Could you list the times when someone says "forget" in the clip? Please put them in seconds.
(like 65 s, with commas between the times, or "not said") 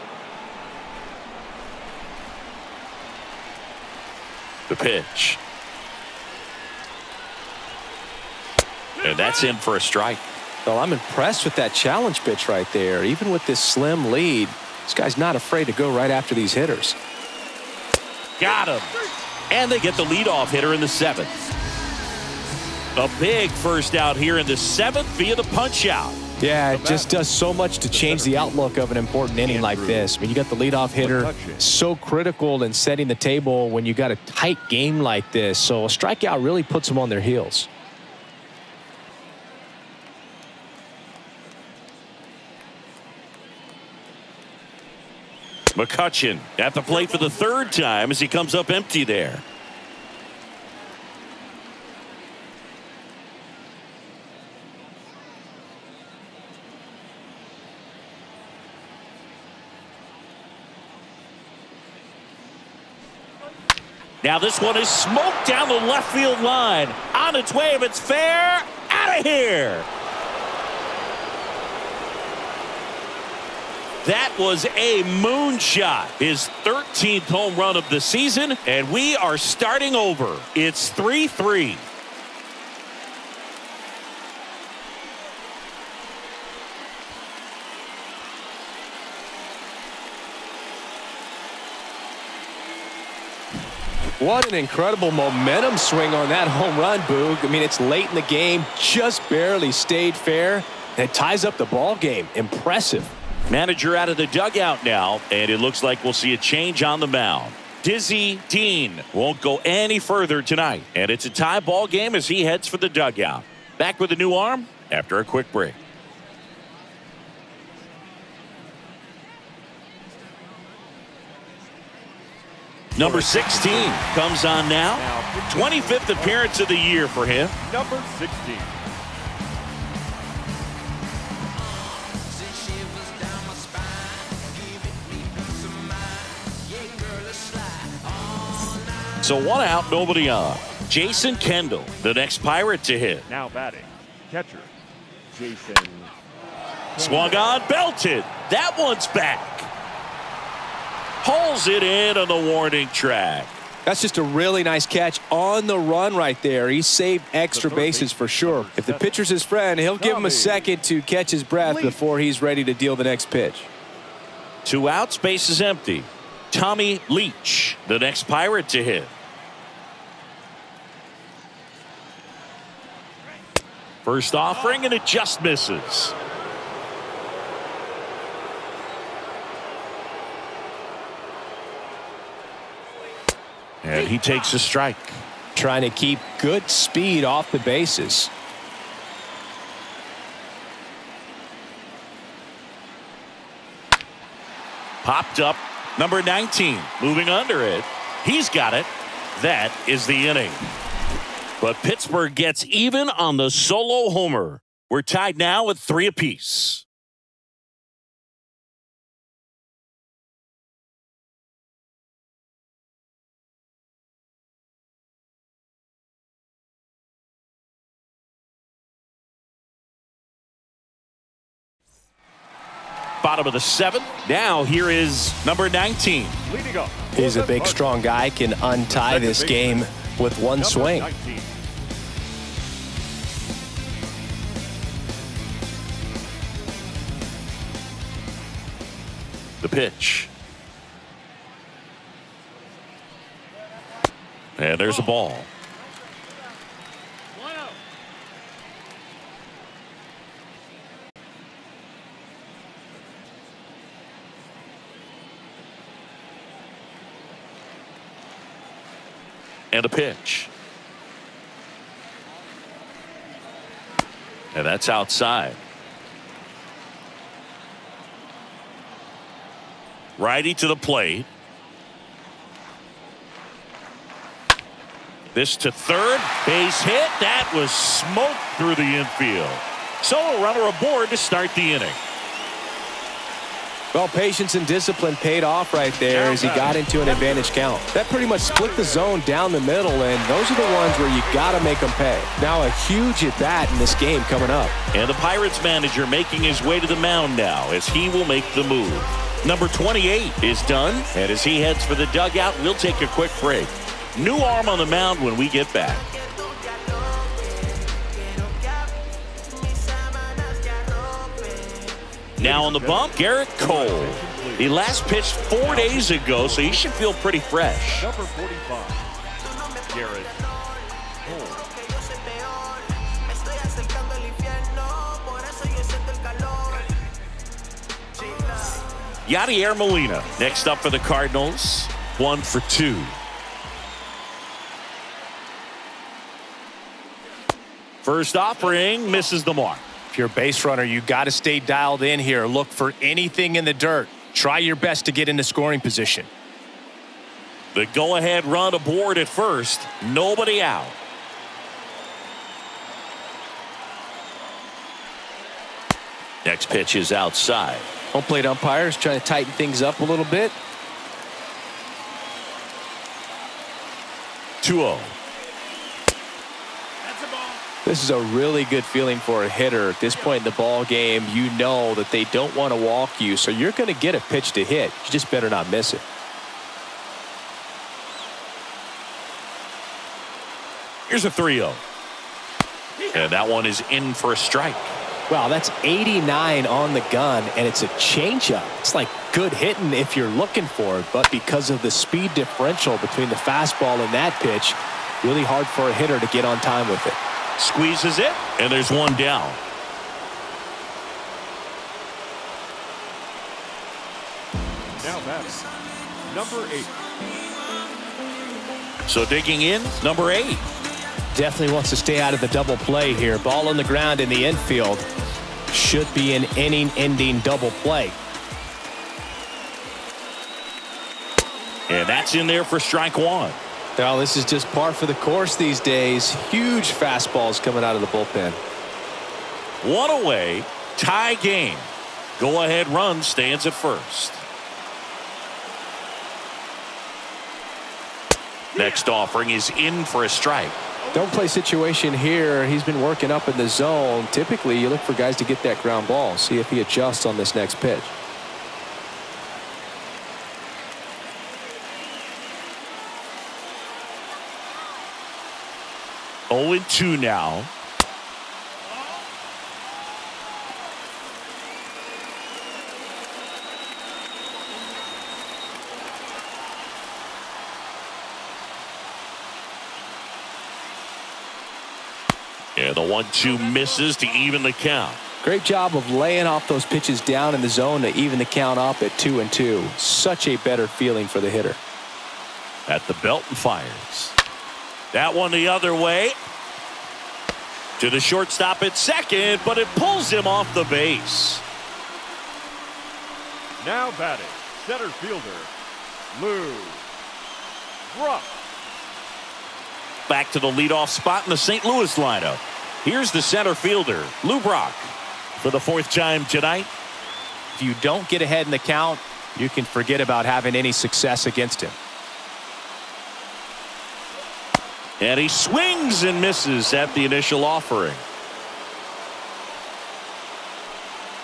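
509 s.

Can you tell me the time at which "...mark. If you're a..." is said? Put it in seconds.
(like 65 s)
339 s.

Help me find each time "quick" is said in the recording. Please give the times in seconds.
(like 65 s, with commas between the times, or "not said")
115 s, 303 s.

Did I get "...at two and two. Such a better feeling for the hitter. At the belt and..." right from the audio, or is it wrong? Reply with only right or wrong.
right.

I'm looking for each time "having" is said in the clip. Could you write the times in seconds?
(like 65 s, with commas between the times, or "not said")
510 s.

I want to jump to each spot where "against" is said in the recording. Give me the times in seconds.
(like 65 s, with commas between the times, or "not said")
511 s.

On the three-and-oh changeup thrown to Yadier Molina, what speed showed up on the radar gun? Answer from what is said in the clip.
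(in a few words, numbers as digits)
89.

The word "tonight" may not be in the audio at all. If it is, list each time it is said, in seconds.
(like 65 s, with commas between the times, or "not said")
110 s, 506 s.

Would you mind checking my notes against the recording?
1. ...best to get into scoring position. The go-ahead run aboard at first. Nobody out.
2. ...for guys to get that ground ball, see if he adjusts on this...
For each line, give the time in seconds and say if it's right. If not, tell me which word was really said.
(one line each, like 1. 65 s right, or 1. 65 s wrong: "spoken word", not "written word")
1. 344 s right
2. 444 s right.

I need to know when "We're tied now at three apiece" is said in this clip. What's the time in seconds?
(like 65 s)
204 s.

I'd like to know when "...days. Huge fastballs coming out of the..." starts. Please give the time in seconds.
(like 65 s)
425 s.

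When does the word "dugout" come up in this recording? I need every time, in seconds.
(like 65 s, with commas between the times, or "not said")
104 s, 112 s, 302 s.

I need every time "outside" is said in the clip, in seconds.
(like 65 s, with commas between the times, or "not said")
264 s, 357 s.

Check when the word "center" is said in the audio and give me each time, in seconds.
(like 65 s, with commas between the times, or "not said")
494 s, 503 s.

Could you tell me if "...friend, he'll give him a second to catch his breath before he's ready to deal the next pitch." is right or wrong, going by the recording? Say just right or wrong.
right.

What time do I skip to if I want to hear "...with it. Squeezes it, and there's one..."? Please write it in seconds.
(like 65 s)
396 s.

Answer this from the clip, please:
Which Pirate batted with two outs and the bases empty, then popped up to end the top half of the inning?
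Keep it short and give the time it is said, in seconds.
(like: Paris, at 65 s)
Tommy Leach, at 166 s.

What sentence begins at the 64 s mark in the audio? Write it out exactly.
Now this one is smoked down the left field line.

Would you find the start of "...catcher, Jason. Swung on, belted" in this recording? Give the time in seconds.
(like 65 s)
144 s.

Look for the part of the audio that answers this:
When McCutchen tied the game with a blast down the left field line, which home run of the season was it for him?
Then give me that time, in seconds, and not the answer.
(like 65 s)
76 s.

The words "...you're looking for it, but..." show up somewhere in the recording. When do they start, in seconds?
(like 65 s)
390 s.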